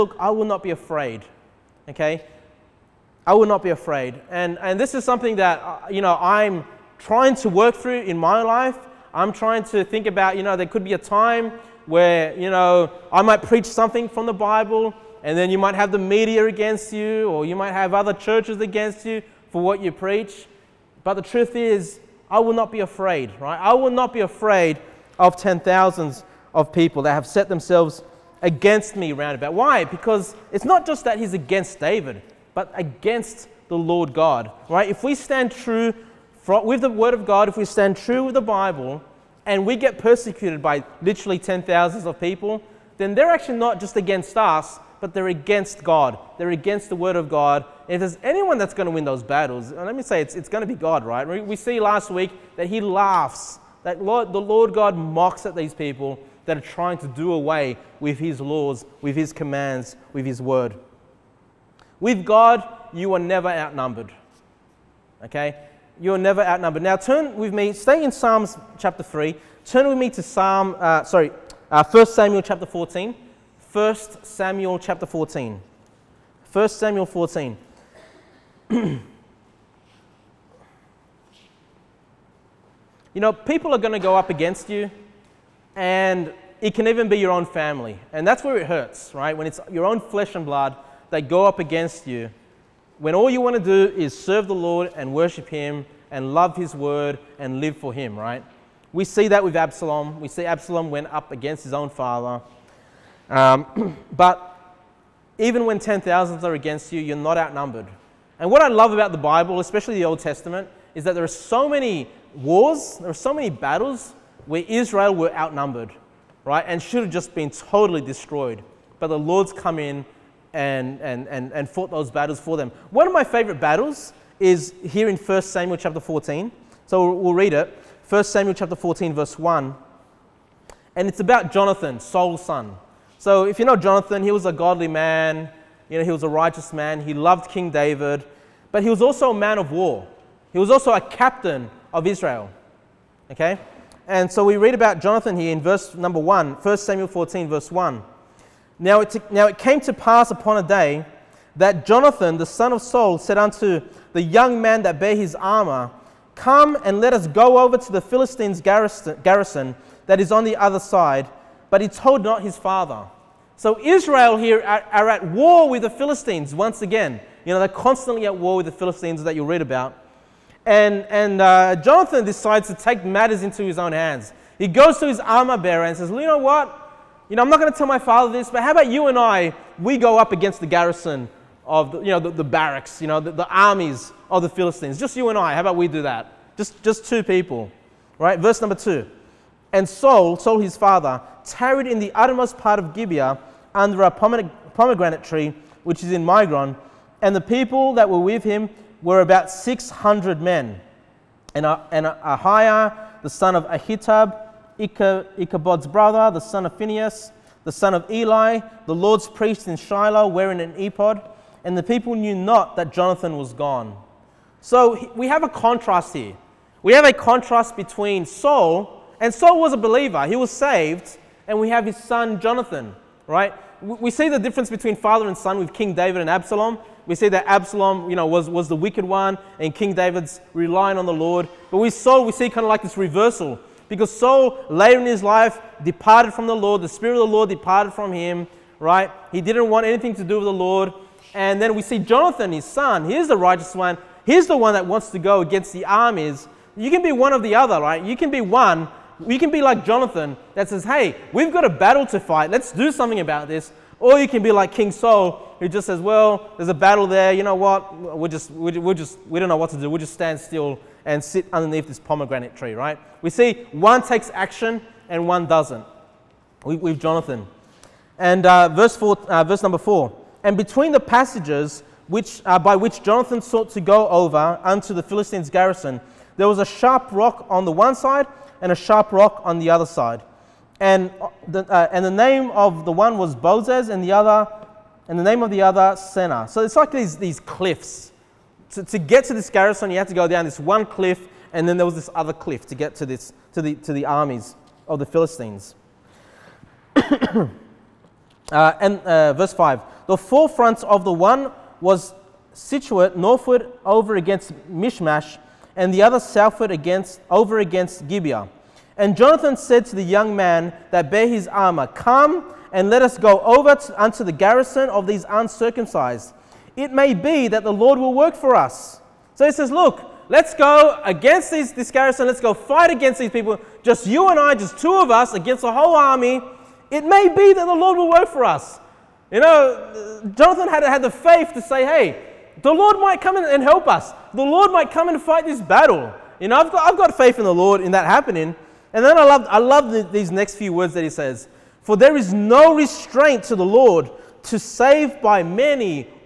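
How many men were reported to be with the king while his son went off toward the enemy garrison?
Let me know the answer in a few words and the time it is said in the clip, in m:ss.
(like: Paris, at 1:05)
600, at 3:19.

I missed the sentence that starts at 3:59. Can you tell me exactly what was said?
He didn't want anything to do with the Lord.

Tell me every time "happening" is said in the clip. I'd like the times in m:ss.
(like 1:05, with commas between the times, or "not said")
5:38.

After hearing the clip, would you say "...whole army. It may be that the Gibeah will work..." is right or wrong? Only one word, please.
wrong.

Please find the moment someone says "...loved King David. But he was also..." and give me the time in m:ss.
2:17.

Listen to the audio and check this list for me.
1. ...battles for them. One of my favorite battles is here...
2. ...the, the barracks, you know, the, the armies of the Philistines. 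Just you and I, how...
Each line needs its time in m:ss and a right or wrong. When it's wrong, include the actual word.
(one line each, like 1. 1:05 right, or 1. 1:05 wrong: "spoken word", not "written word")
1. 2:02 right
2. 3:02 right.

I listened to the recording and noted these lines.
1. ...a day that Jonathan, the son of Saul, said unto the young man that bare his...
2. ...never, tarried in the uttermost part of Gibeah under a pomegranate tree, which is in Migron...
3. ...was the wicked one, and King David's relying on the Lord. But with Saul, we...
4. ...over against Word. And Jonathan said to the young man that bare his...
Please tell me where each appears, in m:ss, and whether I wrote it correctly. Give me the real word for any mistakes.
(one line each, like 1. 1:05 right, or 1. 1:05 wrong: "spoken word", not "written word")
1. 2:30 right
2. 3:10 wrong: "father", not "never"
3. 3:48 right
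4. 5:07 wrong: "Gibeah", not "Word".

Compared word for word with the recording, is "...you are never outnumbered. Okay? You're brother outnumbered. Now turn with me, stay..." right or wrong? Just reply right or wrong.
wrong.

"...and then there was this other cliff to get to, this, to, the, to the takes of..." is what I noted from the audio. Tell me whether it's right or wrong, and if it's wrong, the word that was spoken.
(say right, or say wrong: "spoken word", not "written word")
wrong: "armies", not "takes".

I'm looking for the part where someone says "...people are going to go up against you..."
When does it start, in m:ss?
1:23.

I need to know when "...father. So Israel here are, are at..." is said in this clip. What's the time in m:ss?
2:42.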